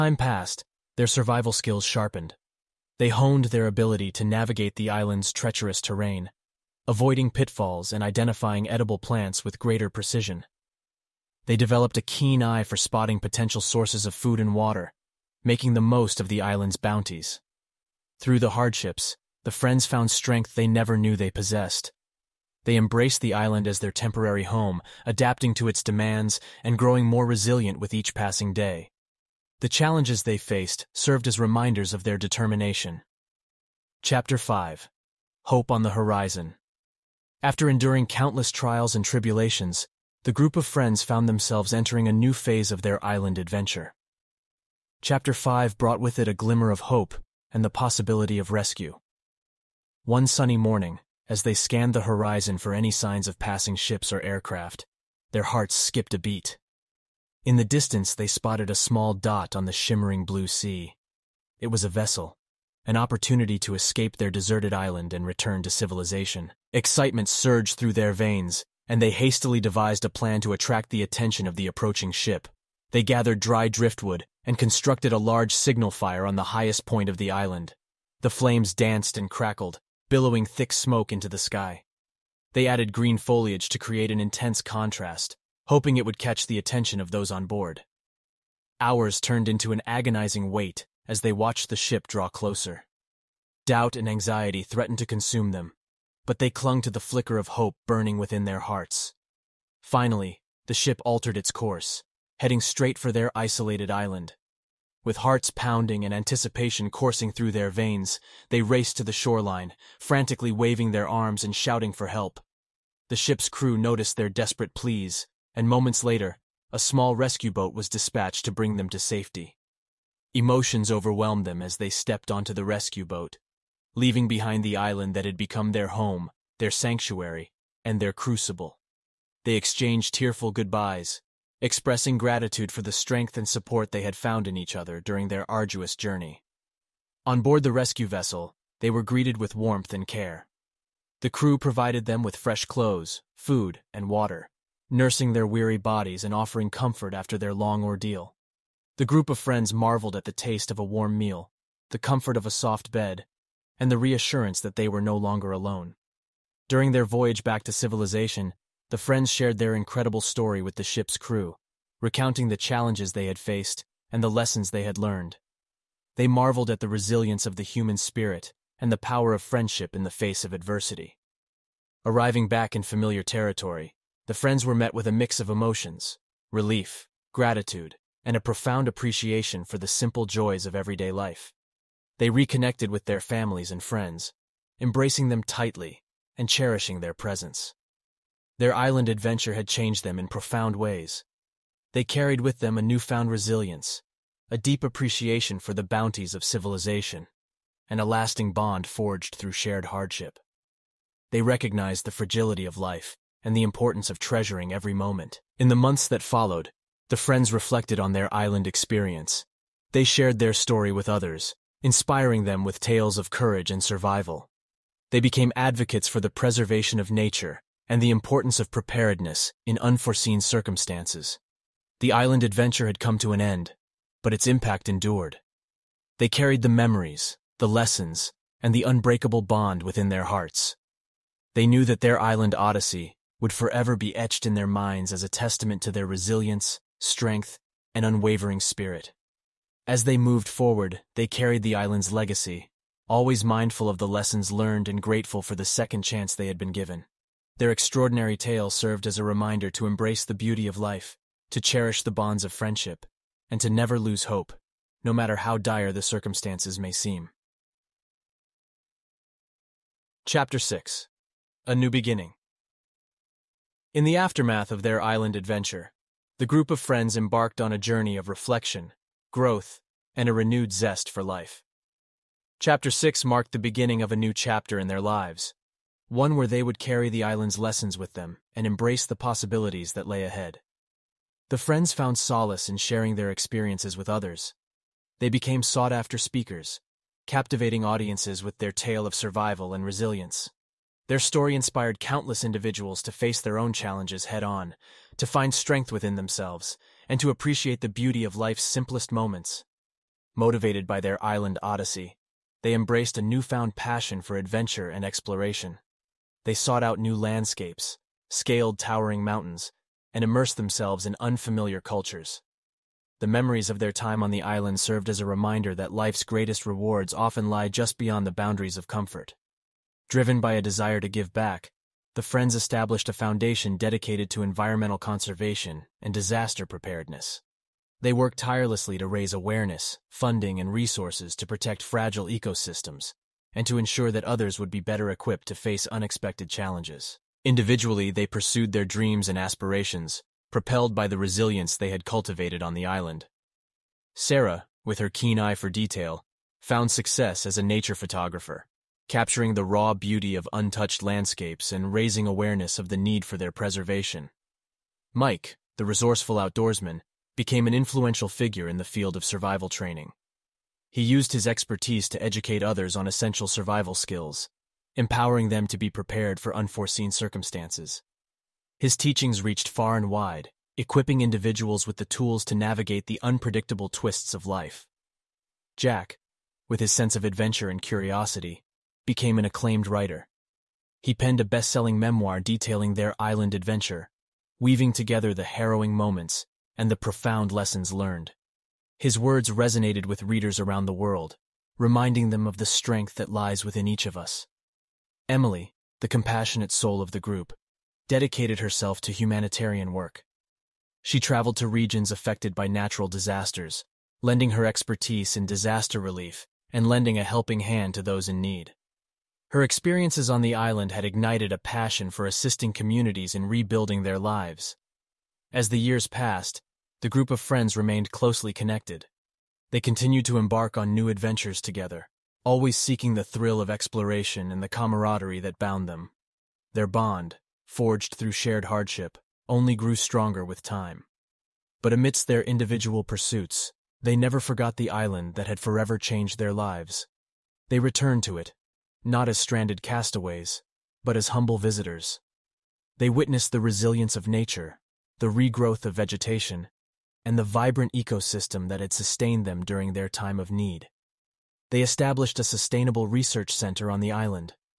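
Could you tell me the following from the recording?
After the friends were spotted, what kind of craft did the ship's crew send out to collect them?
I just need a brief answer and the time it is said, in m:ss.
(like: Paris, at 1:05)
small rescue boat, at 1:56.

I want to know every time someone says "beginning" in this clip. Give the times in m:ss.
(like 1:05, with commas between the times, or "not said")
4:21, 4:33.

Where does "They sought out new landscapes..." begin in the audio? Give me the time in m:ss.
5:06.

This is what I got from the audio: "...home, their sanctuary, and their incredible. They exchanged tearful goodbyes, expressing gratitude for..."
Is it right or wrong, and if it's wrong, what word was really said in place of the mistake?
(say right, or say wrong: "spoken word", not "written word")
wrong: "crucible", not "incredible".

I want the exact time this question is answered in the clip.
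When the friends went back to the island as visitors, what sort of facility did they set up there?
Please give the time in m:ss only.
7:32.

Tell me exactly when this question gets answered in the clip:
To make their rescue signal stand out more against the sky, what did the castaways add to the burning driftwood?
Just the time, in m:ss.
1:22.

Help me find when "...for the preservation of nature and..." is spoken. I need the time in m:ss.
3:36.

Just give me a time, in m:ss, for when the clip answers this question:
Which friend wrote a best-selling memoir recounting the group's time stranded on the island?
6:15.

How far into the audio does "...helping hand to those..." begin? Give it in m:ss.
6:47.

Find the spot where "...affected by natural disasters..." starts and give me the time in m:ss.
6:42.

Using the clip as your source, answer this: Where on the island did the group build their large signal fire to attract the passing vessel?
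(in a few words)
highest point of the island.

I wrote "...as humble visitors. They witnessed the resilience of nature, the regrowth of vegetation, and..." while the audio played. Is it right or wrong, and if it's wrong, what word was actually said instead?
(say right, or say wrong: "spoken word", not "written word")
right.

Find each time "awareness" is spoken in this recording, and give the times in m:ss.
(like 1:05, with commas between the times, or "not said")
5:29, 5:52.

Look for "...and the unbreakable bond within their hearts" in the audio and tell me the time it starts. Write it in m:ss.
3:48.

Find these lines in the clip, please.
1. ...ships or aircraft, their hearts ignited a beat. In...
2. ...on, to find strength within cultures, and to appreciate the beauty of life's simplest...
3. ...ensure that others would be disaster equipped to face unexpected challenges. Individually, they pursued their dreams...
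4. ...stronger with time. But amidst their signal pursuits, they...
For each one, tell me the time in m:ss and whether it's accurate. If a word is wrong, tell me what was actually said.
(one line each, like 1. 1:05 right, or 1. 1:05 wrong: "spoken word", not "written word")
1. 0:53 wrong: "skipped", not "ignited"
2. 4:54 wrong: "themselves", not "cultures"
3. 5:33 wrong: "better", not "disaster"
4. 7:09 wrong: "individual", not "signal".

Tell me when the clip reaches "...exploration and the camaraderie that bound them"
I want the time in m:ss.
7:03.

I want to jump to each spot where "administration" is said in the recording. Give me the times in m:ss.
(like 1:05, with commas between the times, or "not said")
not said.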